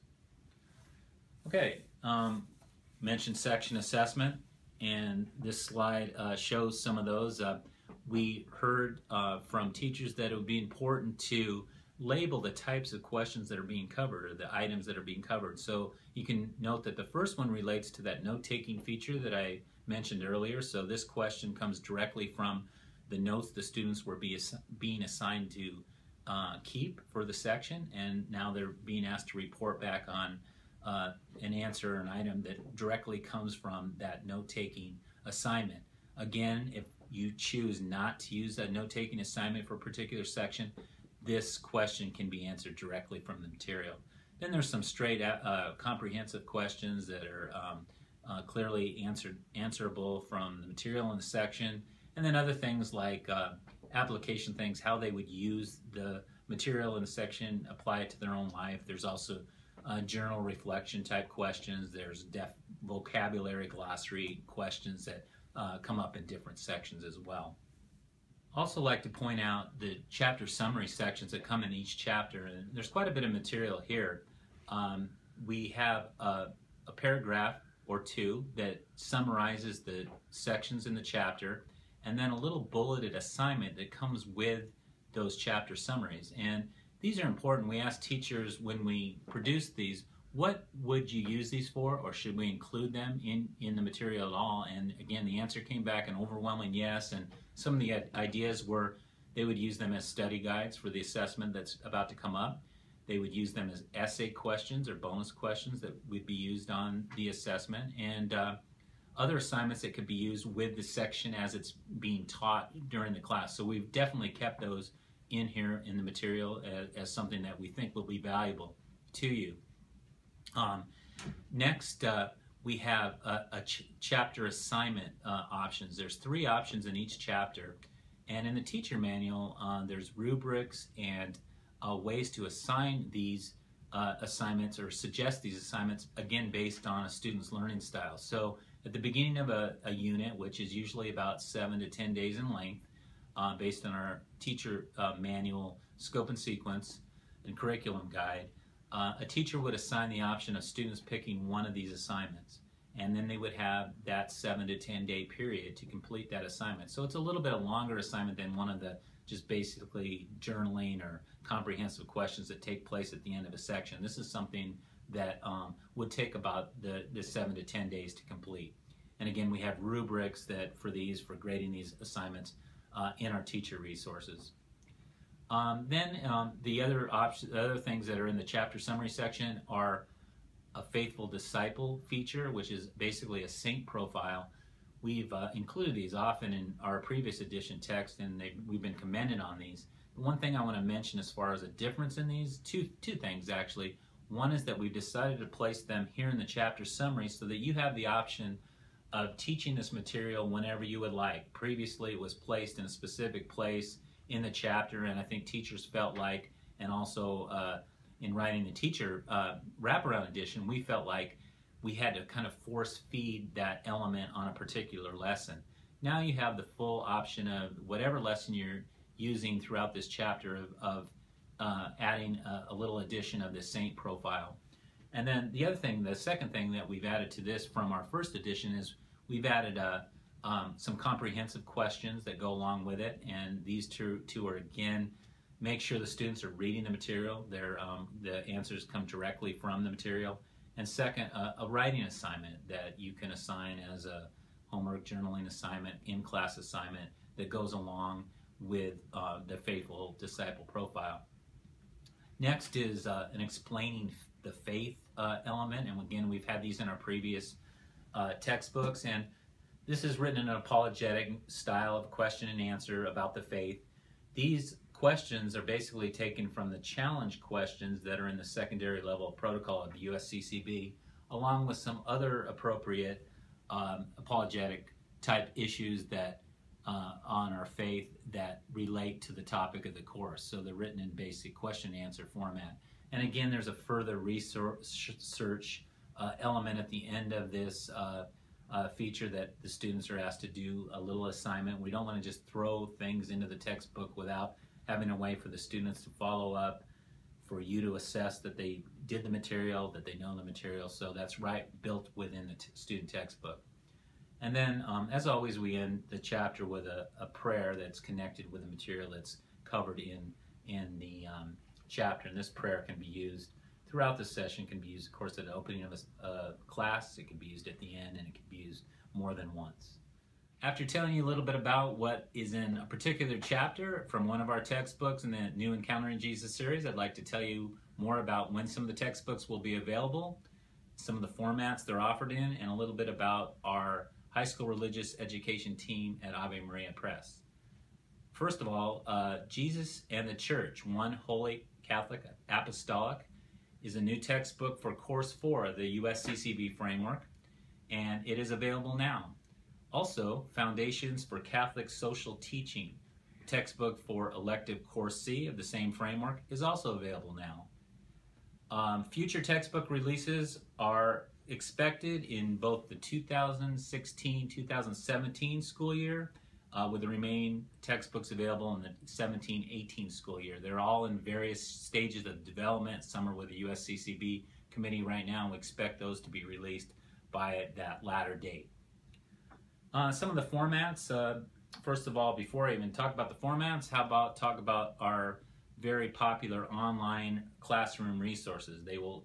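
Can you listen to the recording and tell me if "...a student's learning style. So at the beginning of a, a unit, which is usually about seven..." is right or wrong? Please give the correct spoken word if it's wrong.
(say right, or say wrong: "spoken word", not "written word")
right.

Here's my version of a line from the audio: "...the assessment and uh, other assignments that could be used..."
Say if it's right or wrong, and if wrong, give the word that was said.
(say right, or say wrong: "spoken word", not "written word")
right.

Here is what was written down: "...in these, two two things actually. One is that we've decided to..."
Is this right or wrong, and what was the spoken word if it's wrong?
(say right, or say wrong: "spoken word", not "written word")
right.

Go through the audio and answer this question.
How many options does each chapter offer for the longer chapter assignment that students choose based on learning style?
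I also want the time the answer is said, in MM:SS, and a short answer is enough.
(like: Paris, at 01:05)
3, at 02:06.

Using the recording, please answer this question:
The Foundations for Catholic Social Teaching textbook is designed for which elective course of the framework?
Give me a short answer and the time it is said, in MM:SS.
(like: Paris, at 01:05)
Course C, at 05:54.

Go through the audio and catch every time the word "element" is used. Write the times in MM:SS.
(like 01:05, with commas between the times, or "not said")
03:33, 04:15, 04:46.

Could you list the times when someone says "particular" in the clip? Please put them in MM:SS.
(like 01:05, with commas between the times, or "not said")
00:39, 03:34, 05:22.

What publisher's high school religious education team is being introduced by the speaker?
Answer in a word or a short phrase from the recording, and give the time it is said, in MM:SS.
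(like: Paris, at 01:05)
Ave Maria Press, at 05:36.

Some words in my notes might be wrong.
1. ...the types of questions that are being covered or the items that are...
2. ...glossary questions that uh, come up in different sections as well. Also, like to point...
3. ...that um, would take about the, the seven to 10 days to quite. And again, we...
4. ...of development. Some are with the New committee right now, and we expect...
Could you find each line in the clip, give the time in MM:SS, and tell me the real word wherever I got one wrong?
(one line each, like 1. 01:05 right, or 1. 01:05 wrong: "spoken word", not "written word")
1. 00:12 right
2. 01:03 right
3. 02:45 wrong: "complete", not "quite"
4. 06:12 wrong: "USCCB", not "New".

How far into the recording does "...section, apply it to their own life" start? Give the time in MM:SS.
00:57.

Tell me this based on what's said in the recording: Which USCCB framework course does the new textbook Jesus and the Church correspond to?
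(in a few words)
Course 4.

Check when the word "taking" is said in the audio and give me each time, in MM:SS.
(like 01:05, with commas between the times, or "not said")
00:18, 00:34, 00:38.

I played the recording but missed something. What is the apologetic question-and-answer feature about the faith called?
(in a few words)
Explaining the Faith.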